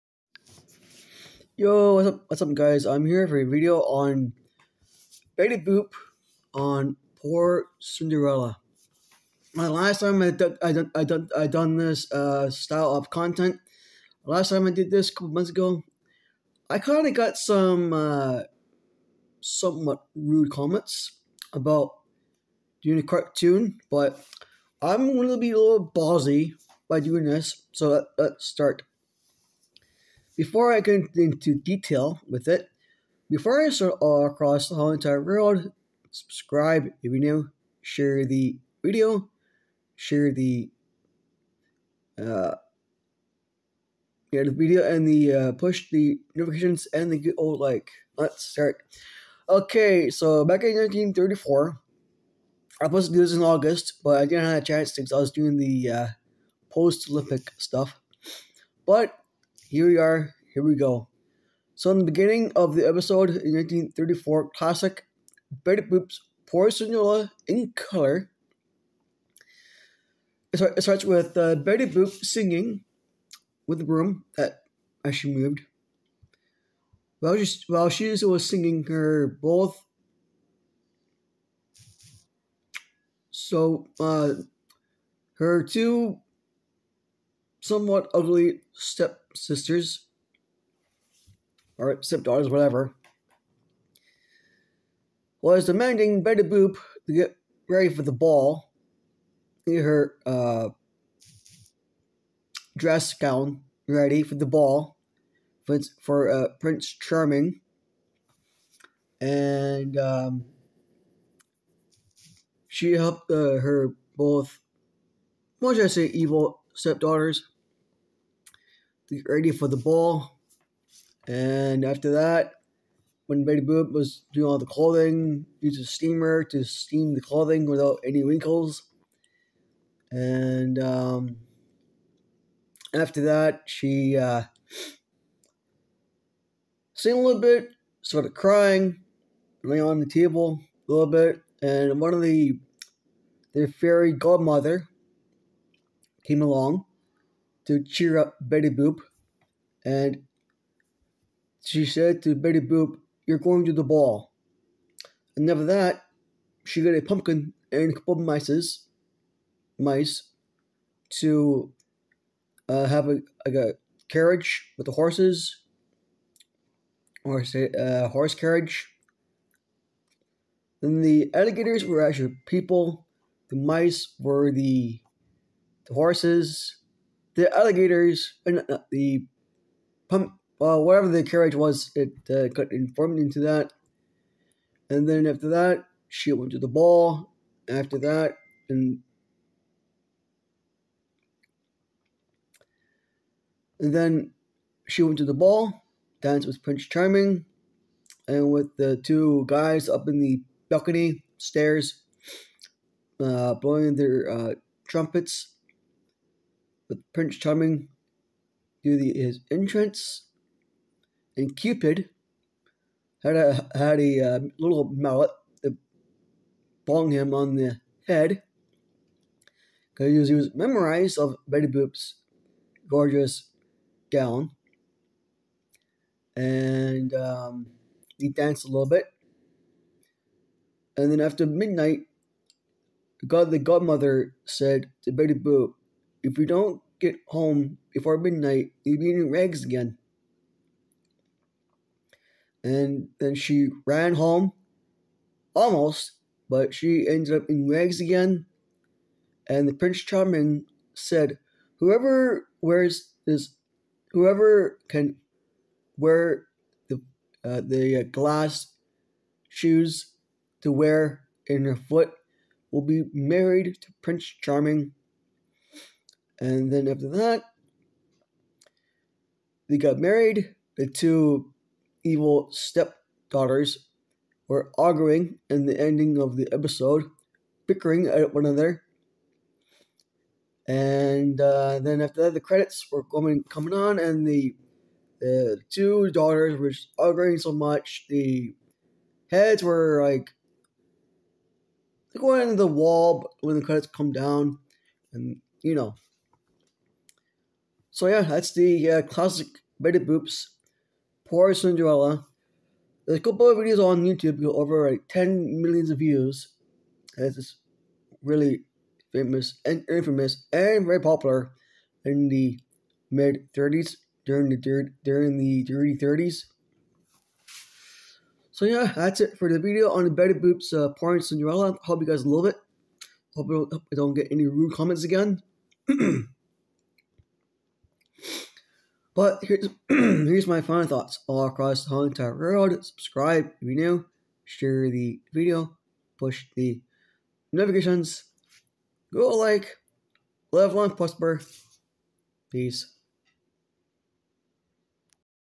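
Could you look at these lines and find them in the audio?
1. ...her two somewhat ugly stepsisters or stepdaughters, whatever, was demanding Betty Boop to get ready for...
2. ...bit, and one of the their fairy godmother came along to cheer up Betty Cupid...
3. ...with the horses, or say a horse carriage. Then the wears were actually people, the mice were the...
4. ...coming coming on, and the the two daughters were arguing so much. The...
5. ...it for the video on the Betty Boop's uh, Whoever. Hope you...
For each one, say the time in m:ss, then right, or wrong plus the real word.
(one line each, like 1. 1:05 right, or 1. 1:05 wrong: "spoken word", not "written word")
1. 1:25 right
2. 2:21 wrong: "Boop", not "Cupid"
3. 2:44 wrong: "alligators", not "wears"
4. 4:43 right
5. 5:19 wrong: "Cinderella", not "Whoever".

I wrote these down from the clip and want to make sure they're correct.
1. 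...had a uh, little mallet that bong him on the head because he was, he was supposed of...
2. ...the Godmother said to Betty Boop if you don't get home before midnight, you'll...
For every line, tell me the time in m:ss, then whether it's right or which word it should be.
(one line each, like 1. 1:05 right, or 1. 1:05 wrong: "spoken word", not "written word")
1. 3:33 wrong: "memorized", not "supposed"
2. 3:53 right.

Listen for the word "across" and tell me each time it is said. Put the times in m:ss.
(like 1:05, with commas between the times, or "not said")
0:34, 5:31.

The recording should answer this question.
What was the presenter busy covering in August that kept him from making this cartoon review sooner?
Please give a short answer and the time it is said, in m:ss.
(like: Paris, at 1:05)
post Olympic stuff, at 0:56.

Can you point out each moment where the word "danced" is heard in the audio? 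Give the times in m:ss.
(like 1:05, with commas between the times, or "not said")
3:16, 3:48.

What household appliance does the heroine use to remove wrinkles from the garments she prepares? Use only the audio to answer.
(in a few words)
a steamer.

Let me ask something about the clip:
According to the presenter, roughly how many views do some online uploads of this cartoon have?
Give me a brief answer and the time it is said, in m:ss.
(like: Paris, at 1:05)
over 10 million, at 5:04.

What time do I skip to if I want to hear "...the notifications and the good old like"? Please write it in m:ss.
0:45.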